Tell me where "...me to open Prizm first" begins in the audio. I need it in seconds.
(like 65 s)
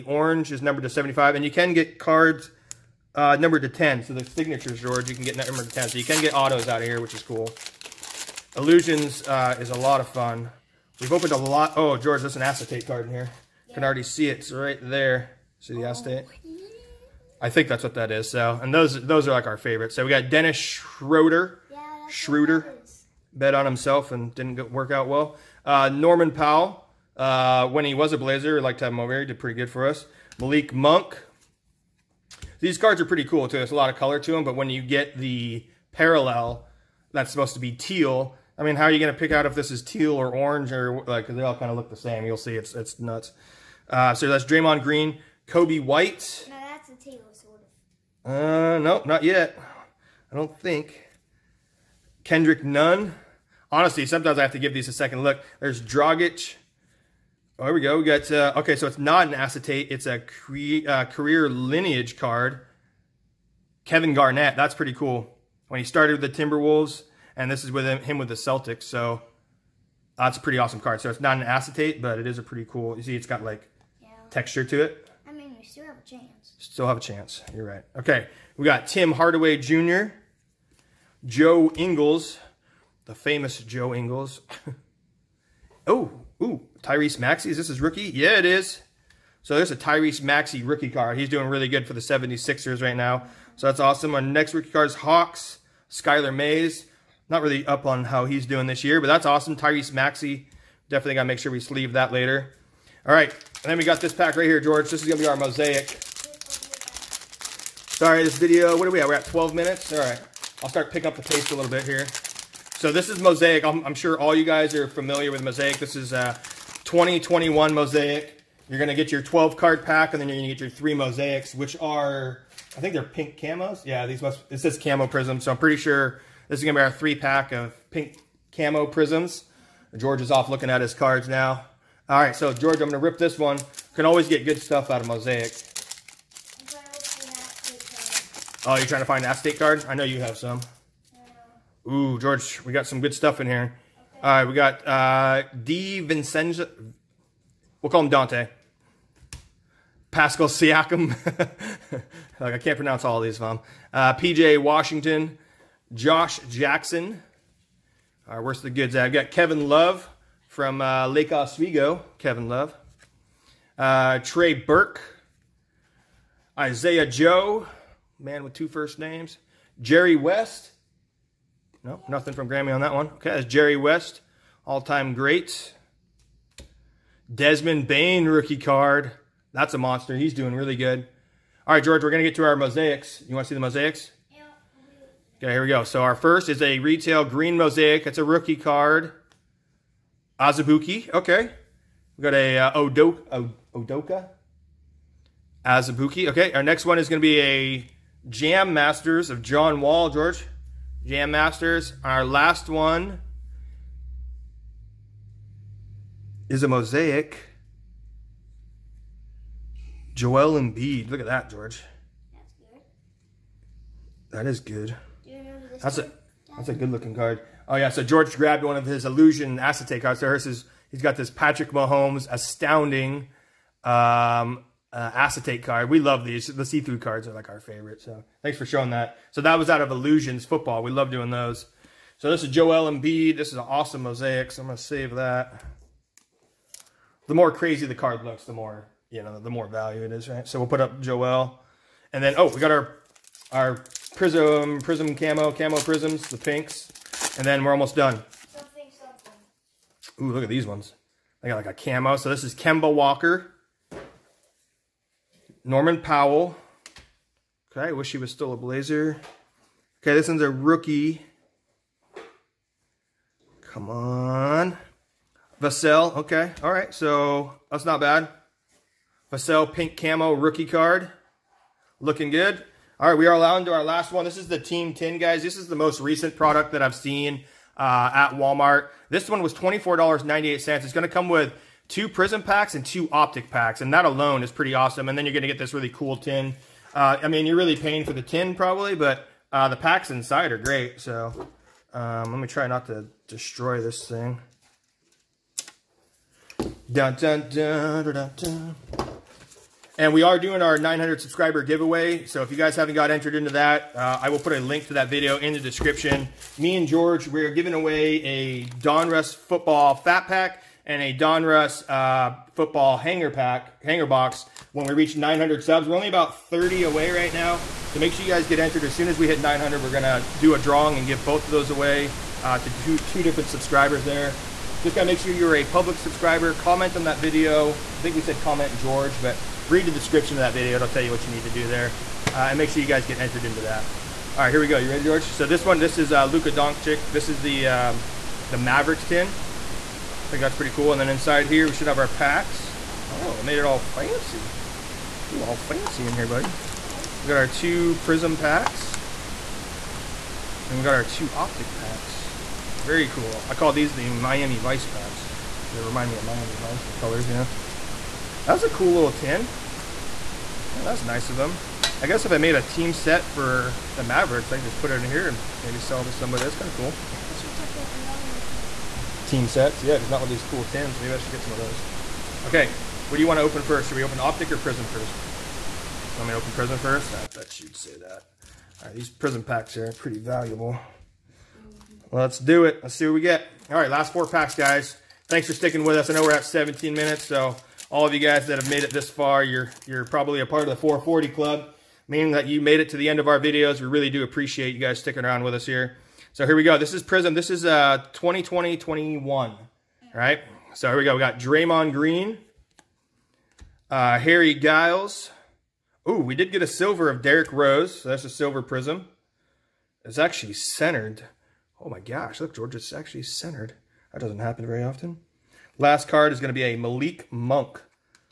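376 s.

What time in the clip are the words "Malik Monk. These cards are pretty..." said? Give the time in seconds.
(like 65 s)
30 s.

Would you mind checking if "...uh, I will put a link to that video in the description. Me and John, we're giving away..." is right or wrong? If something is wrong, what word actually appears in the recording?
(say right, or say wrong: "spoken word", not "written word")
wrong: "George", not "John".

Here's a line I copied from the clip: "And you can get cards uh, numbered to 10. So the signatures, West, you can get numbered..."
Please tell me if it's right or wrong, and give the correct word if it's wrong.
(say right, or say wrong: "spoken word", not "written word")
wrong: "George", not "West".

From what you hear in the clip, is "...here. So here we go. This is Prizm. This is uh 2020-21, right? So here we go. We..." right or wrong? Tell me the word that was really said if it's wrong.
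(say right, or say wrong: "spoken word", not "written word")
right.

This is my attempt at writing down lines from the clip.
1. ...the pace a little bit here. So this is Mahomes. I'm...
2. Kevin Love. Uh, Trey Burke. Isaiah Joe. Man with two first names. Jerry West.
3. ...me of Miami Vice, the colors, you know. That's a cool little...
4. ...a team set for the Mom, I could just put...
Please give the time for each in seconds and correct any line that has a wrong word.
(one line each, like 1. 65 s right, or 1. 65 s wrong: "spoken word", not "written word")
1. 111 s wrong: "Mosaic", not "Mahomes"
2. 162 s right
3. 356 s right
4. 362 s wrong: "Mavericks", not "Mom".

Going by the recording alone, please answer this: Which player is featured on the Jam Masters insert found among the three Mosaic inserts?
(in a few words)
John Wall.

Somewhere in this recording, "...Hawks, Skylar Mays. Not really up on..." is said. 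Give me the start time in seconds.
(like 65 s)
94 s.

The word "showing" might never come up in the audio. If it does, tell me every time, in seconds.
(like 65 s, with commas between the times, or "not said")
228 s.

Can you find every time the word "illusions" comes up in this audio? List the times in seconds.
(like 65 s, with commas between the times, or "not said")
8 s, 219 s, 229 s.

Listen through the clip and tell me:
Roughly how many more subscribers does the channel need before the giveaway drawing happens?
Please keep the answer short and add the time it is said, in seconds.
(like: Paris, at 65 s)
30, at 316 s.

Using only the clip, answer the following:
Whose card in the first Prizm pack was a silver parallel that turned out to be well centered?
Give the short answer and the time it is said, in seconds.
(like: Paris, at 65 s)
Derrick Rose, at 407 s.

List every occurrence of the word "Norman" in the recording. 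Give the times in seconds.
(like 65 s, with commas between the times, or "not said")
25 s, 255 s.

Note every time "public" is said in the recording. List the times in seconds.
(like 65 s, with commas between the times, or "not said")
325 s.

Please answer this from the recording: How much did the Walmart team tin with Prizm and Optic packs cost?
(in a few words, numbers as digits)
$24.98.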